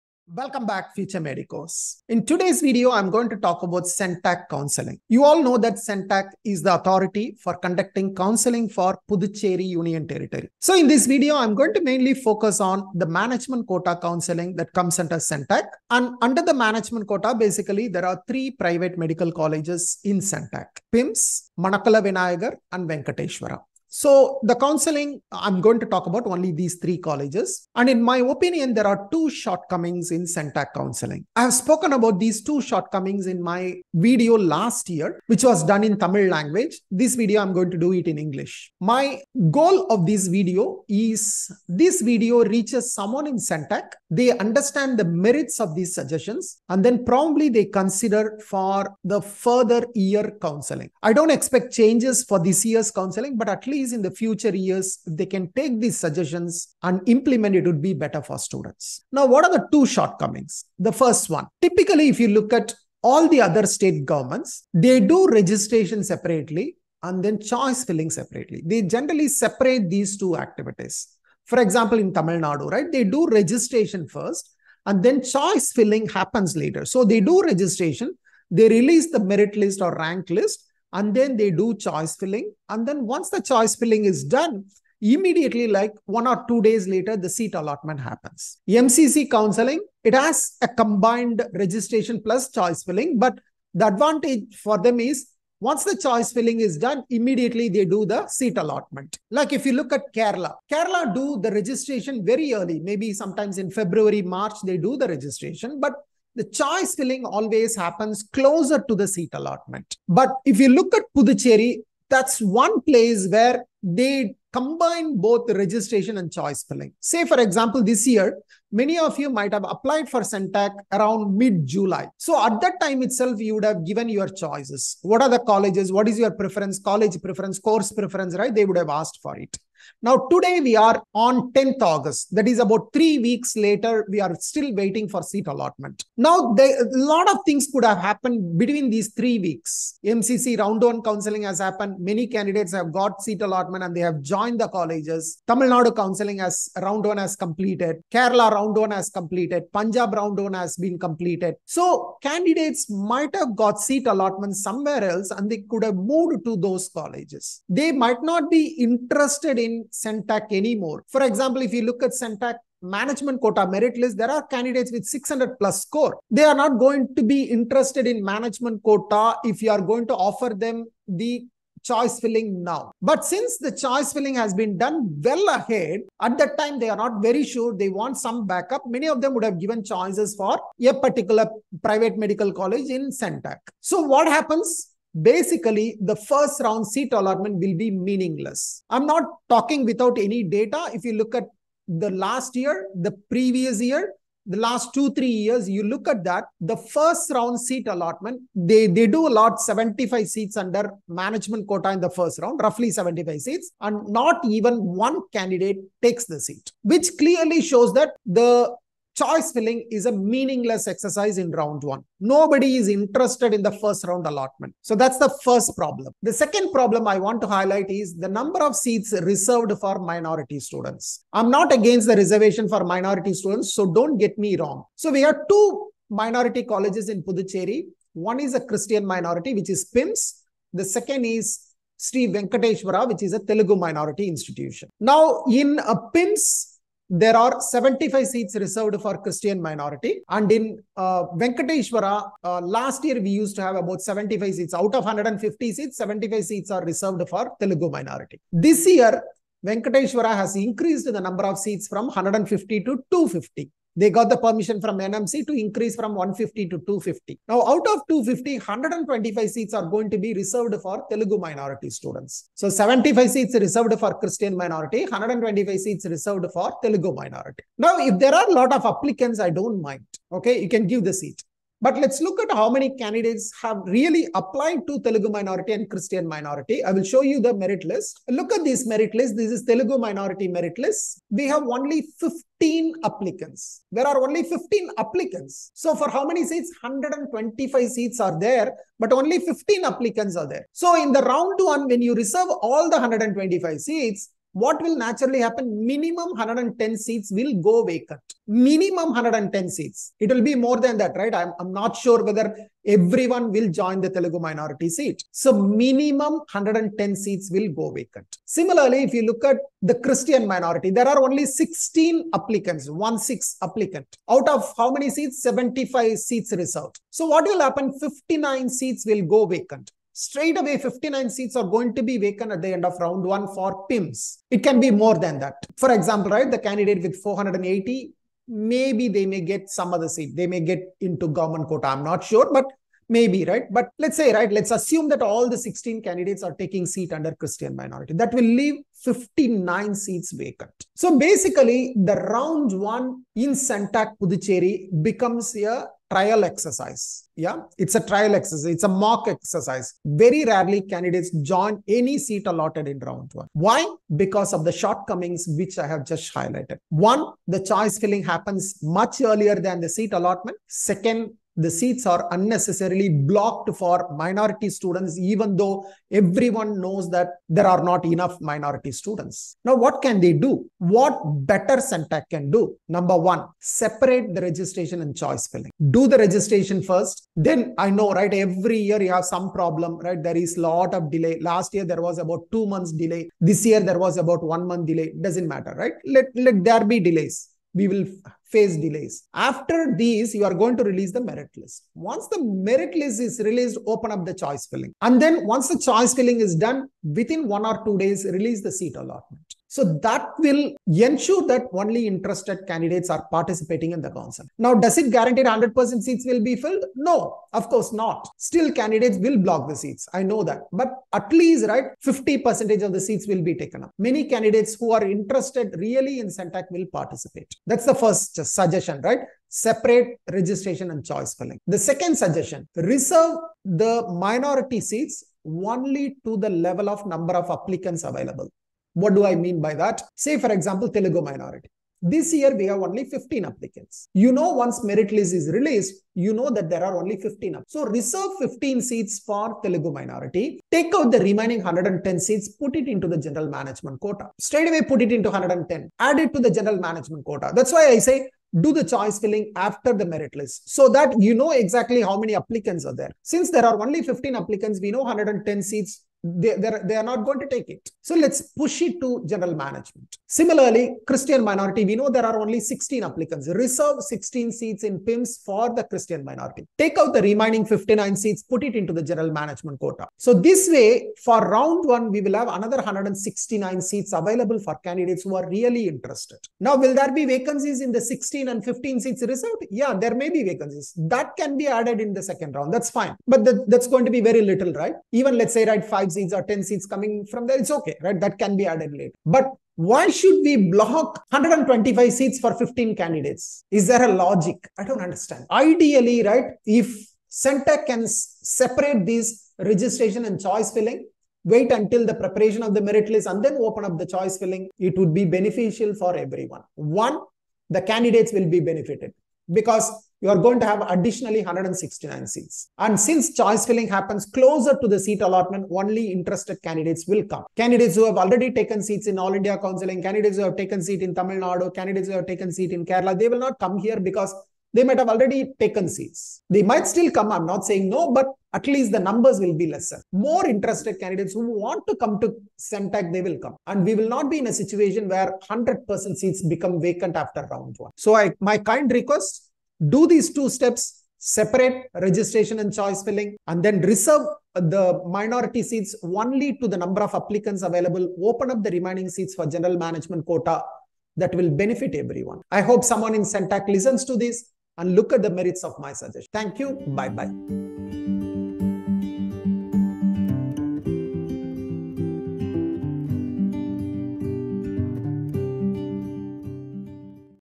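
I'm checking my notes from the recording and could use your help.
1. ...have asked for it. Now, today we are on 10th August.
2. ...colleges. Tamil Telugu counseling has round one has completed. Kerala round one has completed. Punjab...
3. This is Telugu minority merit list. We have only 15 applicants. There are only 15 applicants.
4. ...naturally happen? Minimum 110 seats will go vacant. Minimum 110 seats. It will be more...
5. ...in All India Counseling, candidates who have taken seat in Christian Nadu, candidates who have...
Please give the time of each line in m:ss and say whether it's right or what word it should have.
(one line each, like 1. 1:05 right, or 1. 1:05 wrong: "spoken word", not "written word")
1. 2:08 right
2. 2:24 wrong: "Nadu", not "Telugu"
3. 4:39 right
4. 4:54 right
5. 8:39 wrong: "Tamil", not "Christian".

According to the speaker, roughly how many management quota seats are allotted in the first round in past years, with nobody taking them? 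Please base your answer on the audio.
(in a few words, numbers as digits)
75.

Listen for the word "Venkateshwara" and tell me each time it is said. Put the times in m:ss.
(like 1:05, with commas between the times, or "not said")
0:22, 3:52, 4:01, 4:09.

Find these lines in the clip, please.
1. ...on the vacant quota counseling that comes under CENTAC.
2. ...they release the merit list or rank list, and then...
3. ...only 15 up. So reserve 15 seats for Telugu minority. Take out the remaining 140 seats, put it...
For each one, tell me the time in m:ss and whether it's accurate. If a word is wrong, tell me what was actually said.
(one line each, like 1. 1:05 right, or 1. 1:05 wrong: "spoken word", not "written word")
1. 0:12 wrong: "management", not "vacant"
2. 1:18 right
3. 7:16 wrong: "110", not "140".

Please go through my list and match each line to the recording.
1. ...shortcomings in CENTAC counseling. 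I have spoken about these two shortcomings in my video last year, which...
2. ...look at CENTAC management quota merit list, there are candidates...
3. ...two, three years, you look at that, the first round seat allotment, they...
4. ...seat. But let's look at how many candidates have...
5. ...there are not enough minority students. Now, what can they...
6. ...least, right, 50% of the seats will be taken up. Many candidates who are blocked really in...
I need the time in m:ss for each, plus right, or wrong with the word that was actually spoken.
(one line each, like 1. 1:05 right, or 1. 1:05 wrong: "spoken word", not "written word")
1. 0:29 right
2. 2:41 right
3. 3:14 right
4. 4:31 right
5. 6:07 right
6. 6:51 wrong: "interested", not "blocked".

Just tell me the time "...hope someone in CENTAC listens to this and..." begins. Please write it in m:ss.
9:12.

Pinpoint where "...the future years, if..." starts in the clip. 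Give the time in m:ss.
0:54.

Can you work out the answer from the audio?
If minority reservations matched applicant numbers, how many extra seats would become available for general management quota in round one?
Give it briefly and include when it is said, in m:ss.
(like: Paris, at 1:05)
169, at 7:52.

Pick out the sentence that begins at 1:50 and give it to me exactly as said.
But if you look at Puducherry, that's one place where they combine both registration and choice filling.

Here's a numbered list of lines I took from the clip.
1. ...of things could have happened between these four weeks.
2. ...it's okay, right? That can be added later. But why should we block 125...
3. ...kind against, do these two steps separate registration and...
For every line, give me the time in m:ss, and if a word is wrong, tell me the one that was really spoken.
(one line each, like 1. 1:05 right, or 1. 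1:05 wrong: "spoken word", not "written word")
1. 2:17 wrong: "three", not "four"
2. 8:07 right
3. 8:58 wrong: "request", not "against".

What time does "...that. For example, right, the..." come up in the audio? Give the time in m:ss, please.
5:25.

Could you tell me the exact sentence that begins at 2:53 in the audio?
But since the choice filling has been done well ahead, at that time they are not very sure they want some backup.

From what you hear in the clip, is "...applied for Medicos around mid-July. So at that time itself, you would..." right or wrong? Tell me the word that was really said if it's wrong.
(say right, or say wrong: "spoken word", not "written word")
wrong: "CENTAC", not "Medicos".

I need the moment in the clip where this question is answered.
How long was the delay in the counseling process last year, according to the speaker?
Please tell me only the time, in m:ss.
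6:22.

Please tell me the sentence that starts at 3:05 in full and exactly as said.
basically the first round seat allotment will be meaningless.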